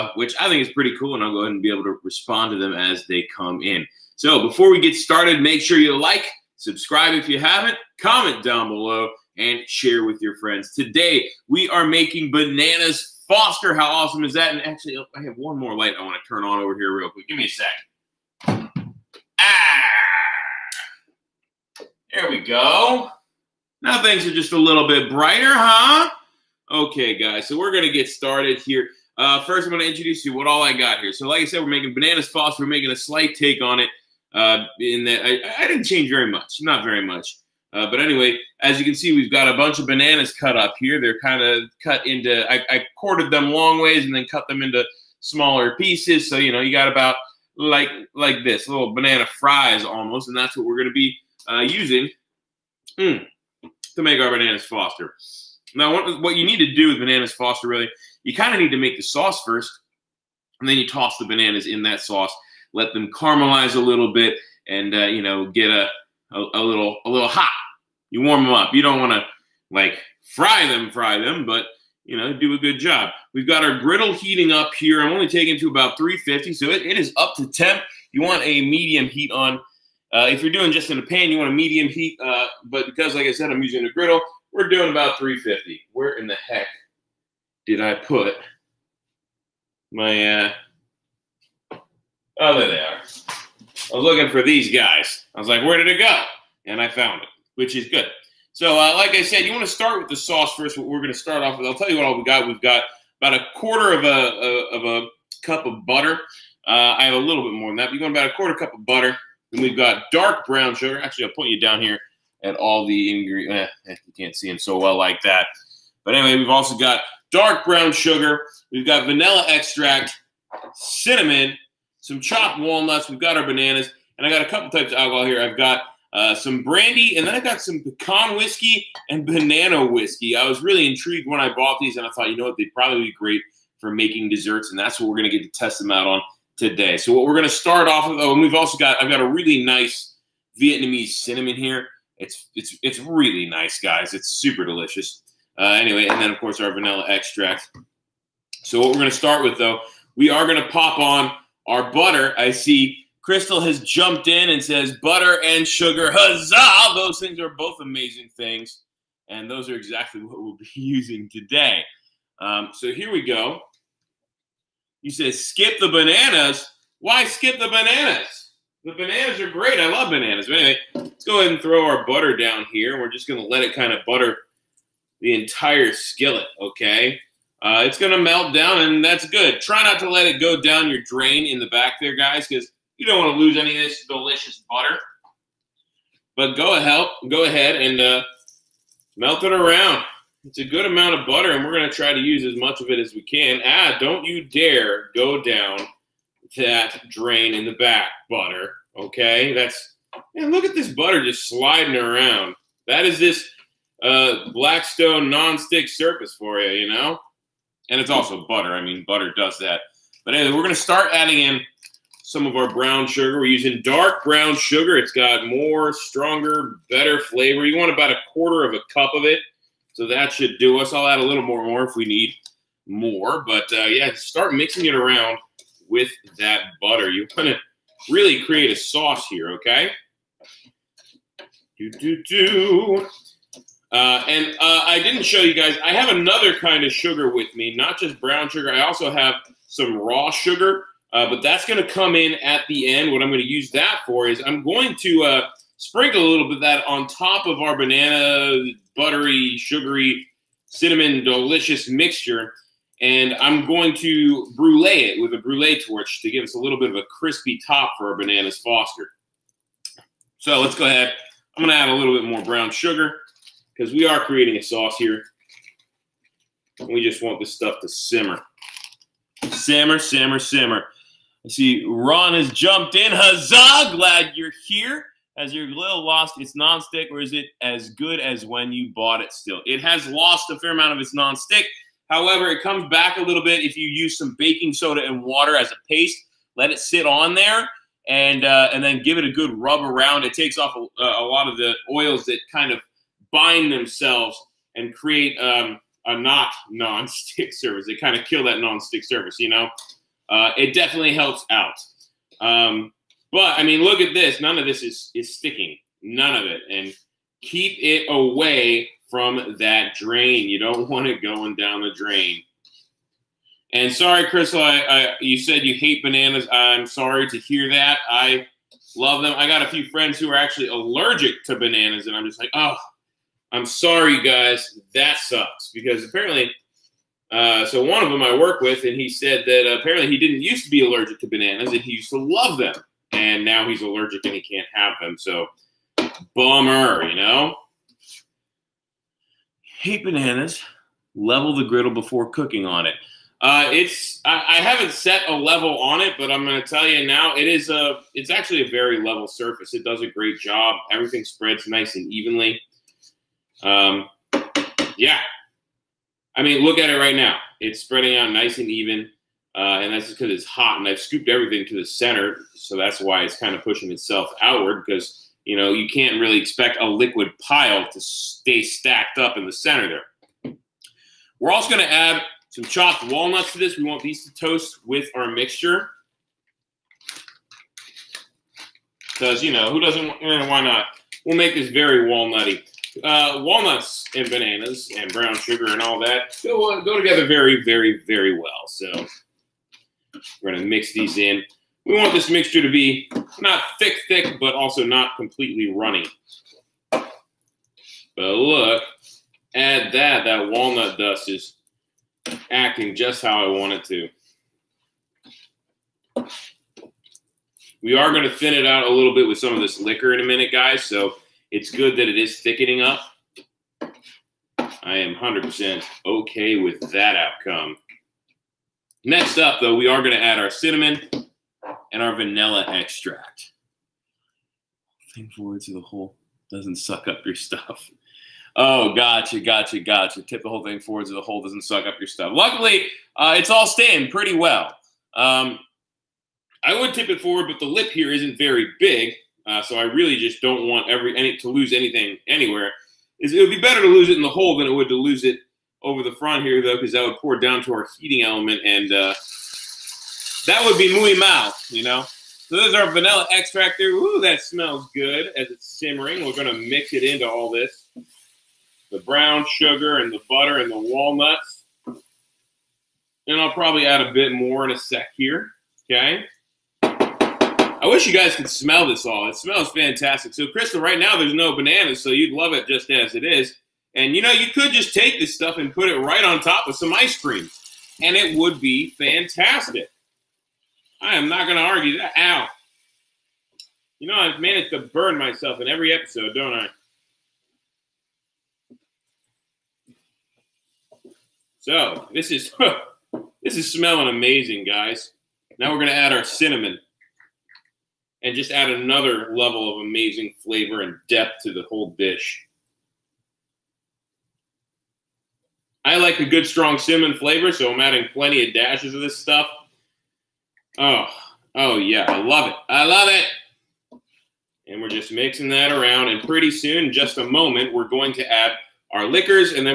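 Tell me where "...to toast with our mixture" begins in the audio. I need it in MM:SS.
06:14.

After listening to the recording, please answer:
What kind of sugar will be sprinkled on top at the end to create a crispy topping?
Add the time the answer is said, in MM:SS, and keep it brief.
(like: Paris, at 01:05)
raw sugar, at 03:59.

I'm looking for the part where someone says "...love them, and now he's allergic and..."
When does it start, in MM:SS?
05:32.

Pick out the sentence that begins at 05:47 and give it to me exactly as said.
It is a it's actually a very level surface.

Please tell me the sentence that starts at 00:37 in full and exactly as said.
Uh, but anyway, as you can see, we've got a bunch of bananas cut up here.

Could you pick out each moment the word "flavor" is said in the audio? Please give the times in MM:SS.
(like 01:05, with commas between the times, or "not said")
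03:37, 08:20, 08:27.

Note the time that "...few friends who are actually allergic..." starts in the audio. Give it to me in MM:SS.
05:19.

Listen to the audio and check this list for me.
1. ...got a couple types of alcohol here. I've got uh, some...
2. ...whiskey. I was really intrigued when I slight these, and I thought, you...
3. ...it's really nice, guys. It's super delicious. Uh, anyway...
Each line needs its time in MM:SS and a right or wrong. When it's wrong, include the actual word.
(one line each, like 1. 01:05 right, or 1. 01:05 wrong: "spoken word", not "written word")
1. 02:04 right
2. 02:09 wrong: "bought", not "slight"
3. 02:22 right.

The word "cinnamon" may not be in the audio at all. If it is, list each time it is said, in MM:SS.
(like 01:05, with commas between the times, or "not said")
02:00, 02:21, 04:10, 07:00, 08:16, 08:26.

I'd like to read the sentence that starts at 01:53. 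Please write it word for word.
Eh, eh, you can't see them so well like that.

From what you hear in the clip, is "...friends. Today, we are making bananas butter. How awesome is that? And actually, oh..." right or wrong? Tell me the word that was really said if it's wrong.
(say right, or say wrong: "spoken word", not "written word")
wrong: "foster", not "butter".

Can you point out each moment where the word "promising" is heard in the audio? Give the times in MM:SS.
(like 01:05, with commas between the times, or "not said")
not said.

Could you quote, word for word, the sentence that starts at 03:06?
But go ahead, go ahead and uh, melt it around.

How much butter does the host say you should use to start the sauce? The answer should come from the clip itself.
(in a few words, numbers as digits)
a quarter cup.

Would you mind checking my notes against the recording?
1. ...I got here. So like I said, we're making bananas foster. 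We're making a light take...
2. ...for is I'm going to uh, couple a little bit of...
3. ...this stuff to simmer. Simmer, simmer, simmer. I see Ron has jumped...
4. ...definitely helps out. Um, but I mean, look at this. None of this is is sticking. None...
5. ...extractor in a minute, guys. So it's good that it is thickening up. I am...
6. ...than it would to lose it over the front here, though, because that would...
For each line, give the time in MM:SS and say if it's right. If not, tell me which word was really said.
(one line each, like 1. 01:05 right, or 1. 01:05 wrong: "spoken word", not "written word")
1. 00:30 wrong: "slight", not "light"
2. 04:04 wrong: "sprinkle", not "couple"
3. 04:27 right
4. 05:00 right
5. 06:49 wrong: "liquor", not "extractor"
6. 07:24 right.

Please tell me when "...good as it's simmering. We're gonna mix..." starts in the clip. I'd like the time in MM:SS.
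07:34.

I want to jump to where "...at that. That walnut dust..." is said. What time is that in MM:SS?
06:39.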